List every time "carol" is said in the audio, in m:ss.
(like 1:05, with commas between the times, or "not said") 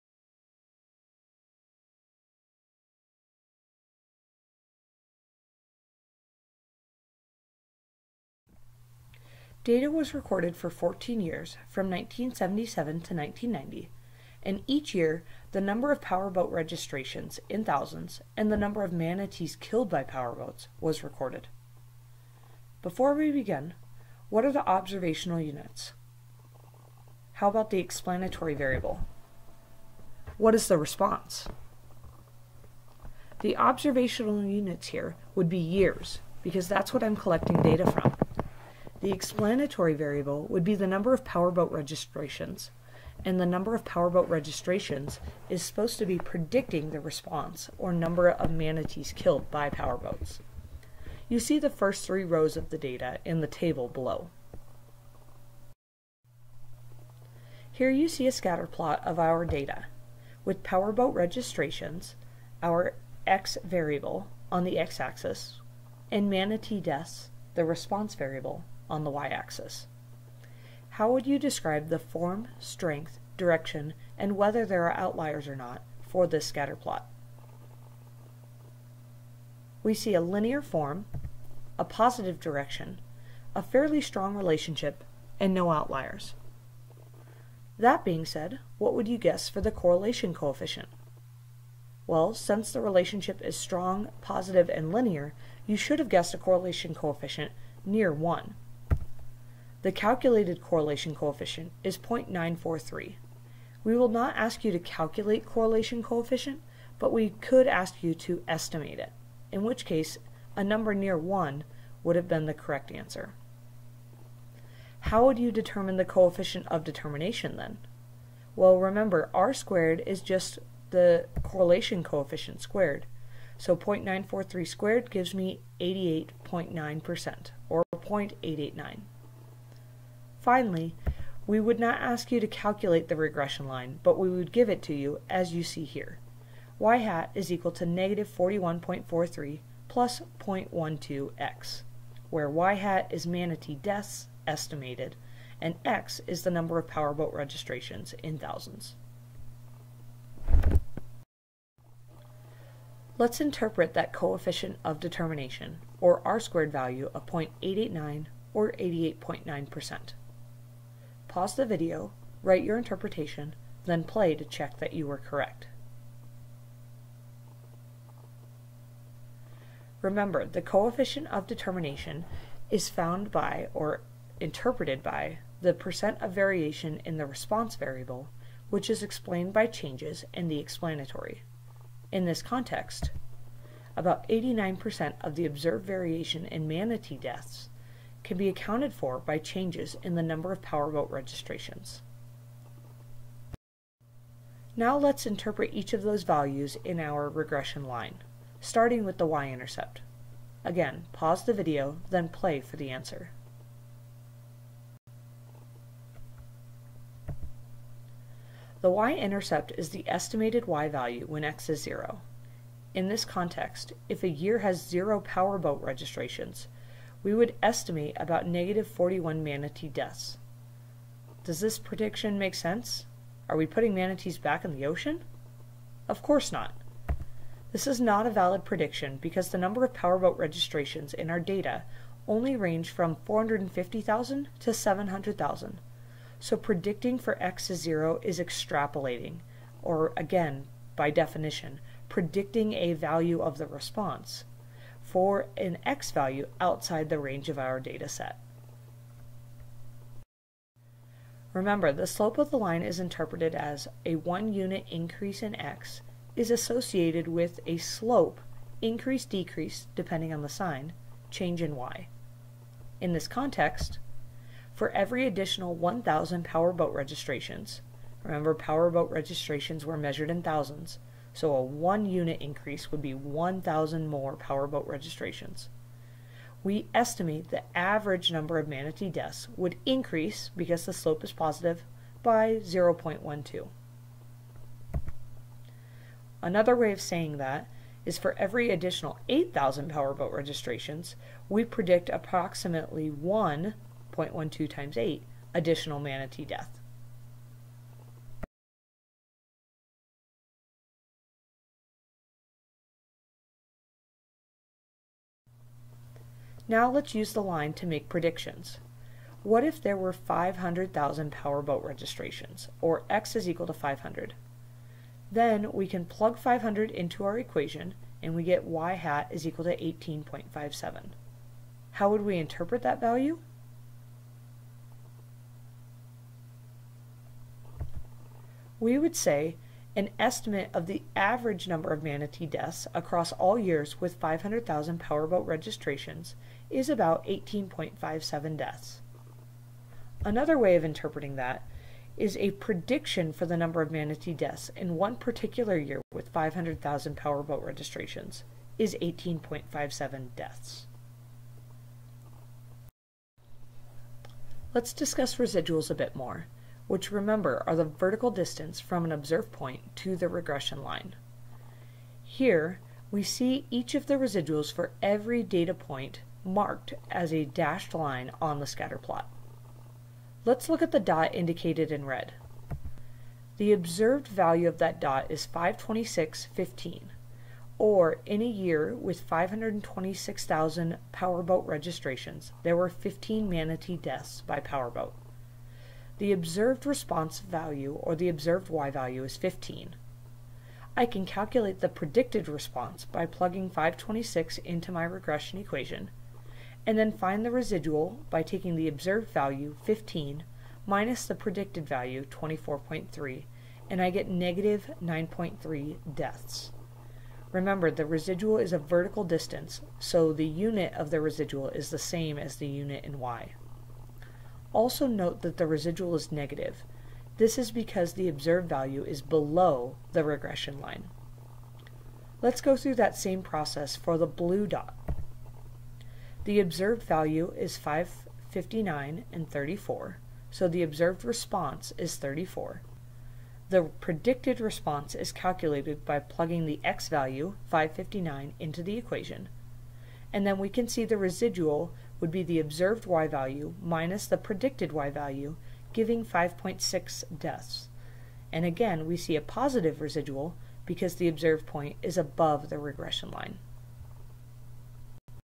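not said.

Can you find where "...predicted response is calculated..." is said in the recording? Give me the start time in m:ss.
7:13.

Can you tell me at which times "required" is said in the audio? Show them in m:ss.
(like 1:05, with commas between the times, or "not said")
not said.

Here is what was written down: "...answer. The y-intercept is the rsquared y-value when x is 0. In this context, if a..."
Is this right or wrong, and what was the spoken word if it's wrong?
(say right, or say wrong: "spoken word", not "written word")
wrong: "estimated", not "rsquared".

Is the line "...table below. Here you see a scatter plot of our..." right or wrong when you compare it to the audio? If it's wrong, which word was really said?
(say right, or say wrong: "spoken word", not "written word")
right.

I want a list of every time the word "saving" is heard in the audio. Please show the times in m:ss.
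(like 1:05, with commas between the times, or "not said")
not said.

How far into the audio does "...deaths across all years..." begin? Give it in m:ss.
5:32.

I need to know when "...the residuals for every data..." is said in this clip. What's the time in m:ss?
6:04.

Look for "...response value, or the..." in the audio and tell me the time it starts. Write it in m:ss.
6:26.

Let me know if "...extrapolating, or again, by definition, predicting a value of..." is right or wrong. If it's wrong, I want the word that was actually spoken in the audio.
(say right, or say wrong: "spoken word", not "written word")
right.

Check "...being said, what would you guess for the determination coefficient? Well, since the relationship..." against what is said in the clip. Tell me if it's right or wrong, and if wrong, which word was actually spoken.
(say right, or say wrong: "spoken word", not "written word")
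wrong: "correlation", not "determination".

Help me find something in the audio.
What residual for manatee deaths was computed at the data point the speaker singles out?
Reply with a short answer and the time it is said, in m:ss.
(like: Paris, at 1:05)
-9.3, at 6:44.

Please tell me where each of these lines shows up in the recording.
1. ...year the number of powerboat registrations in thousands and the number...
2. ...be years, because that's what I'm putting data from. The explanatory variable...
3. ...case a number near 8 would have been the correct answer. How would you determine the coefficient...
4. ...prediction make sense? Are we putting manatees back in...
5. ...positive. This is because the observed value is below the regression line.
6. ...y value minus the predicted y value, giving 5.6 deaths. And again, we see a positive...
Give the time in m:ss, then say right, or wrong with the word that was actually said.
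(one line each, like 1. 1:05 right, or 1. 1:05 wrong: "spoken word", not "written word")
1. 0:14 right
2. 0:35 wrong: "collecting", not "putting"
3. 1:49 wrong: "1", not "8"
4. 3:41 right
5. 6:56 wrong: "negative", not "positive"
6. 7:23 right.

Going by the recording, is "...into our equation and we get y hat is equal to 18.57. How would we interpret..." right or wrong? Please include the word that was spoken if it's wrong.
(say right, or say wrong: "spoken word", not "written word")
right.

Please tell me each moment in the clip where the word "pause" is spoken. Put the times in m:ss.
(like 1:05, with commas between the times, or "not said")
2:41, 3:21.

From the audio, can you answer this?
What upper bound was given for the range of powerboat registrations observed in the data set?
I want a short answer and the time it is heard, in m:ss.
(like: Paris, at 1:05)
700,000, at 3:54.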